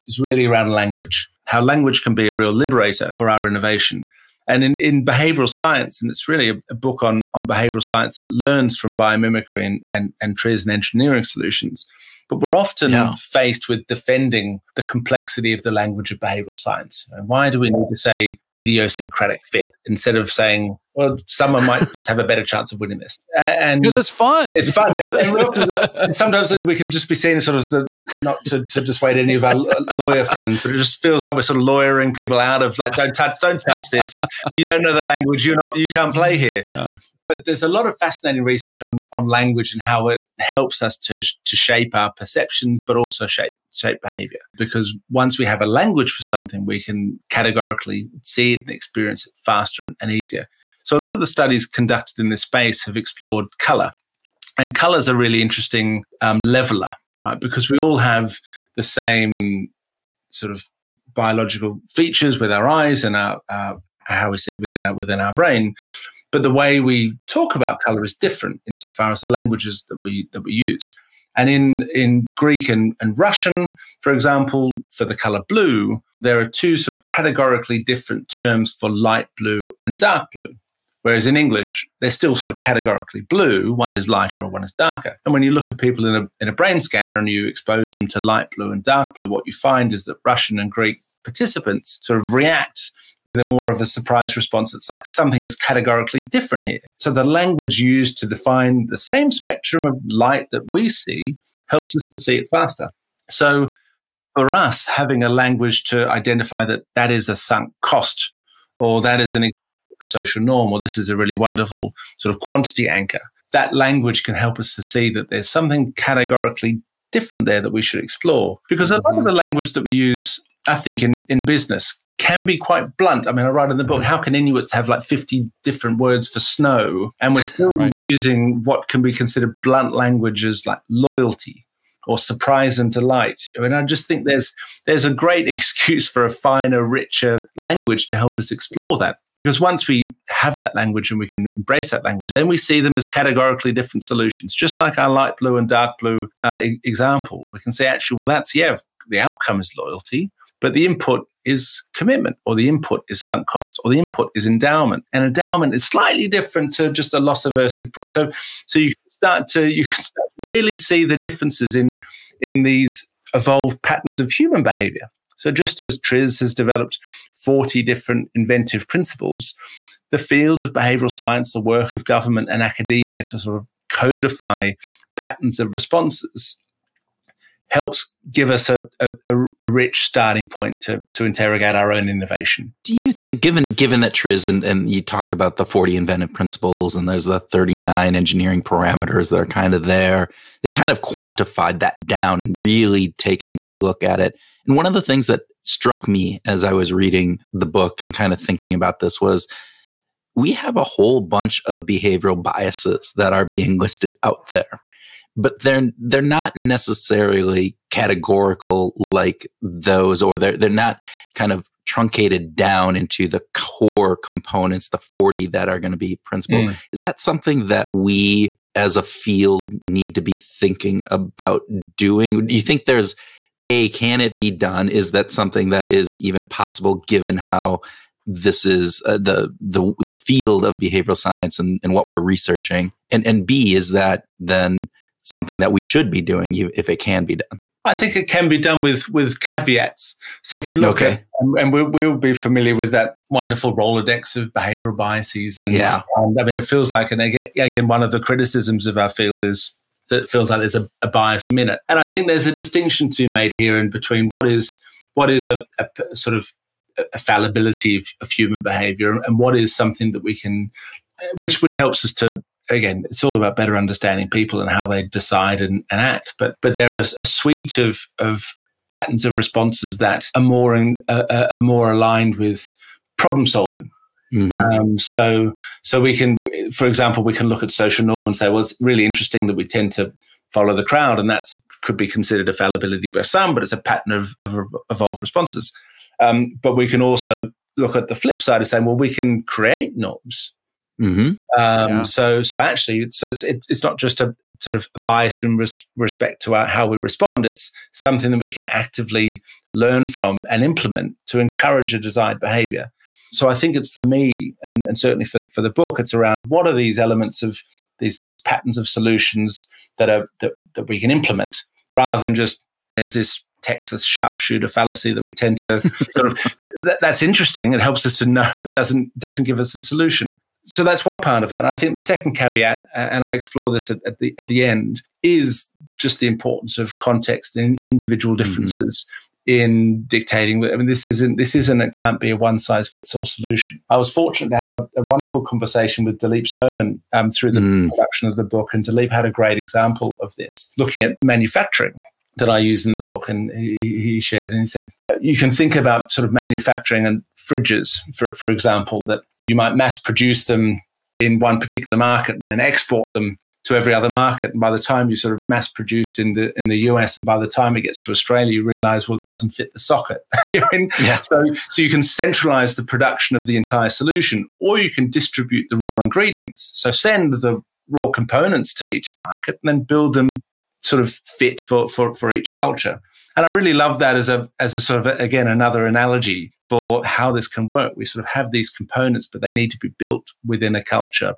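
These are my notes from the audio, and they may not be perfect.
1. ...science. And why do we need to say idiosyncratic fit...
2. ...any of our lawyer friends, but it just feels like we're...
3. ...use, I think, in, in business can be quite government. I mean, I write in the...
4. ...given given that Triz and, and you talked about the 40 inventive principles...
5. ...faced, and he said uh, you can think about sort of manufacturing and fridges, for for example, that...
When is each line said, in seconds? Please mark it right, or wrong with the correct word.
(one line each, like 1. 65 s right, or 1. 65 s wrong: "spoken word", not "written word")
1. 16 s right
2. 29 s right
3. 119 s wrong: "blunt", not "government"
4. 183 s right
5. 344 s wrong: "shared", not "faced".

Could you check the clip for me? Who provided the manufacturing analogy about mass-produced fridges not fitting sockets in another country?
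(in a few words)
Dilip Soman.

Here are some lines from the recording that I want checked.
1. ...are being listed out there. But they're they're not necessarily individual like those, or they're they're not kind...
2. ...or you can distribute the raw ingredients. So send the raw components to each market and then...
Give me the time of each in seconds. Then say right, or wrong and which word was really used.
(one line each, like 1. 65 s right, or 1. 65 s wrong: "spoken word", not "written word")
1. 203 s wrong: "categorical", not "individual"
2. 364 s right.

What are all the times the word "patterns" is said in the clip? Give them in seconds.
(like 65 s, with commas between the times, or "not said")
163 s, 175 s, 268 s, 283 s, 308 s.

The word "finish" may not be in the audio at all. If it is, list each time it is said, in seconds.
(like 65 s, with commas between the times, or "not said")
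not said.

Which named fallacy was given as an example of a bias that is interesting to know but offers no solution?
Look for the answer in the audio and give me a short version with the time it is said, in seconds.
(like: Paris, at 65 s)
Texas sharpshooter fallacy, at 313 s.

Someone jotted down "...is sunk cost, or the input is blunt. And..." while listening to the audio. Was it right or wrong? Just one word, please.
wrong.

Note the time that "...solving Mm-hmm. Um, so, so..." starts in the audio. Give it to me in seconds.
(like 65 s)
273 s.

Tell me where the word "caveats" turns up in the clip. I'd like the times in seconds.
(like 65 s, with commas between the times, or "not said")
239 s, 322 s.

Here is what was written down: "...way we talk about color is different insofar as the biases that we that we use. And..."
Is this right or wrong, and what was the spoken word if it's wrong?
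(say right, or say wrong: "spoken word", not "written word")
wrong: "languages", not "biases".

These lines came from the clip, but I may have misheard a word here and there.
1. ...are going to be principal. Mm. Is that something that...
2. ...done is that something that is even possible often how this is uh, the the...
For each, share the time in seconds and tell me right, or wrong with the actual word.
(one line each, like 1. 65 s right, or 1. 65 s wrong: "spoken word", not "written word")
1. 215 s right
2. 224 s wrong: "given", not "often".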